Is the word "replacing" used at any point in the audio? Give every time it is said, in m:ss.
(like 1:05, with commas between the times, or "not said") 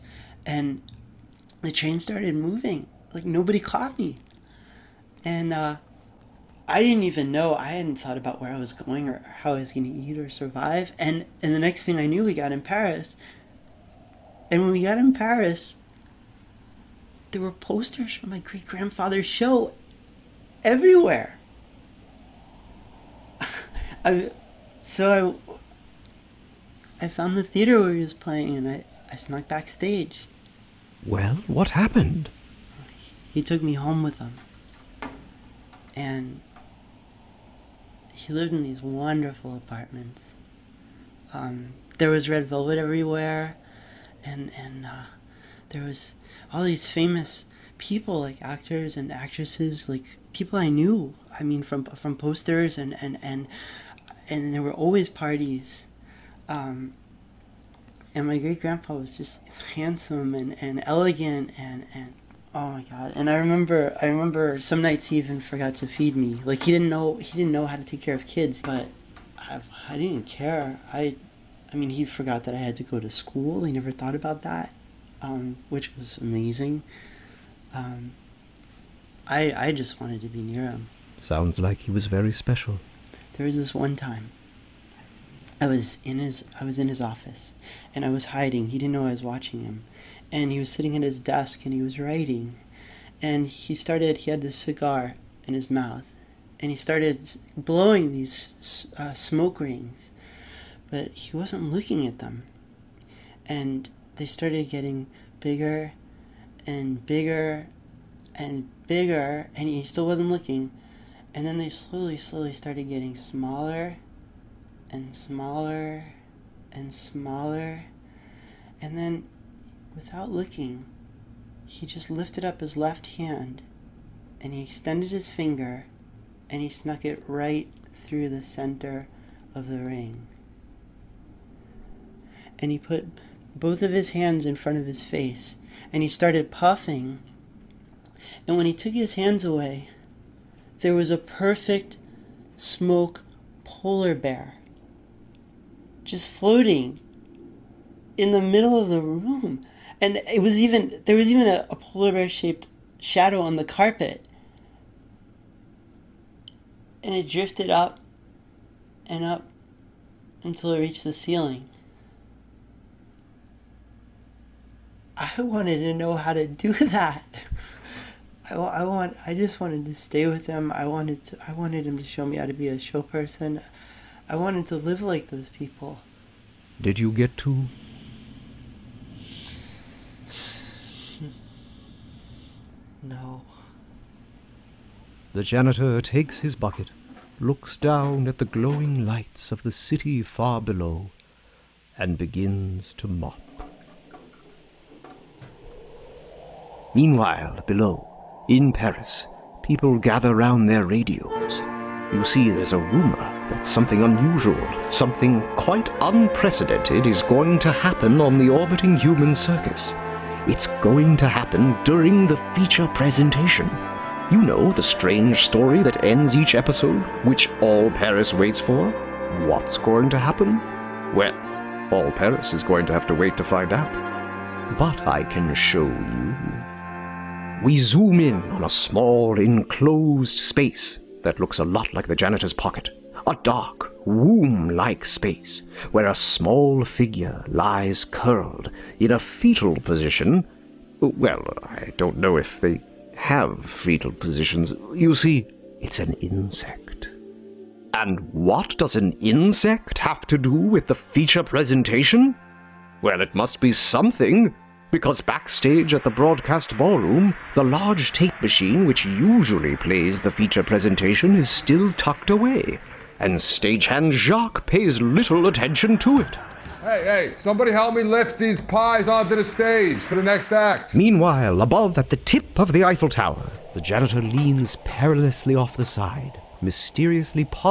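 not said.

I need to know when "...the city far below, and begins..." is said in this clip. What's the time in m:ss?
3:09.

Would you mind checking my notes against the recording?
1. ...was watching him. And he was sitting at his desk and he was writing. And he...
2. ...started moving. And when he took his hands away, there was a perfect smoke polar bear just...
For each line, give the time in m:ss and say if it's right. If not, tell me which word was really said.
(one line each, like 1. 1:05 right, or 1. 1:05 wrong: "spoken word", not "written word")
1. 1:29 right
2. 2:16 wrong: "puffing", not "moving".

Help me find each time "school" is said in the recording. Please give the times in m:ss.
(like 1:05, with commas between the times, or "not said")
1:13.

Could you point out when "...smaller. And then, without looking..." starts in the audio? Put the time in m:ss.
1:56.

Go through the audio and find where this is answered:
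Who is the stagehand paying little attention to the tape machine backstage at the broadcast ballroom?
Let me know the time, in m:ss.
4:24.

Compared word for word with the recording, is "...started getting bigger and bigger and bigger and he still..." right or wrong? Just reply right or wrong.
right.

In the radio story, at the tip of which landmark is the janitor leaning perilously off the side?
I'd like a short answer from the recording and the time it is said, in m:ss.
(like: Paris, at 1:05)
Eiffel Tower, at 4:32.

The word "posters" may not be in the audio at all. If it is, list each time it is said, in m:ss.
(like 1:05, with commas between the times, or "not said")
0:17, 0:52.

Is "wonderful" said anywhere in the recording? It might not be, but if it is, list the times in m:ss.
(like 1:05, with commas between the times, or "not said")
0:38.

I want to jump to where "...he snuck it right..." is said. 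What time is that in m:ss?
2:06.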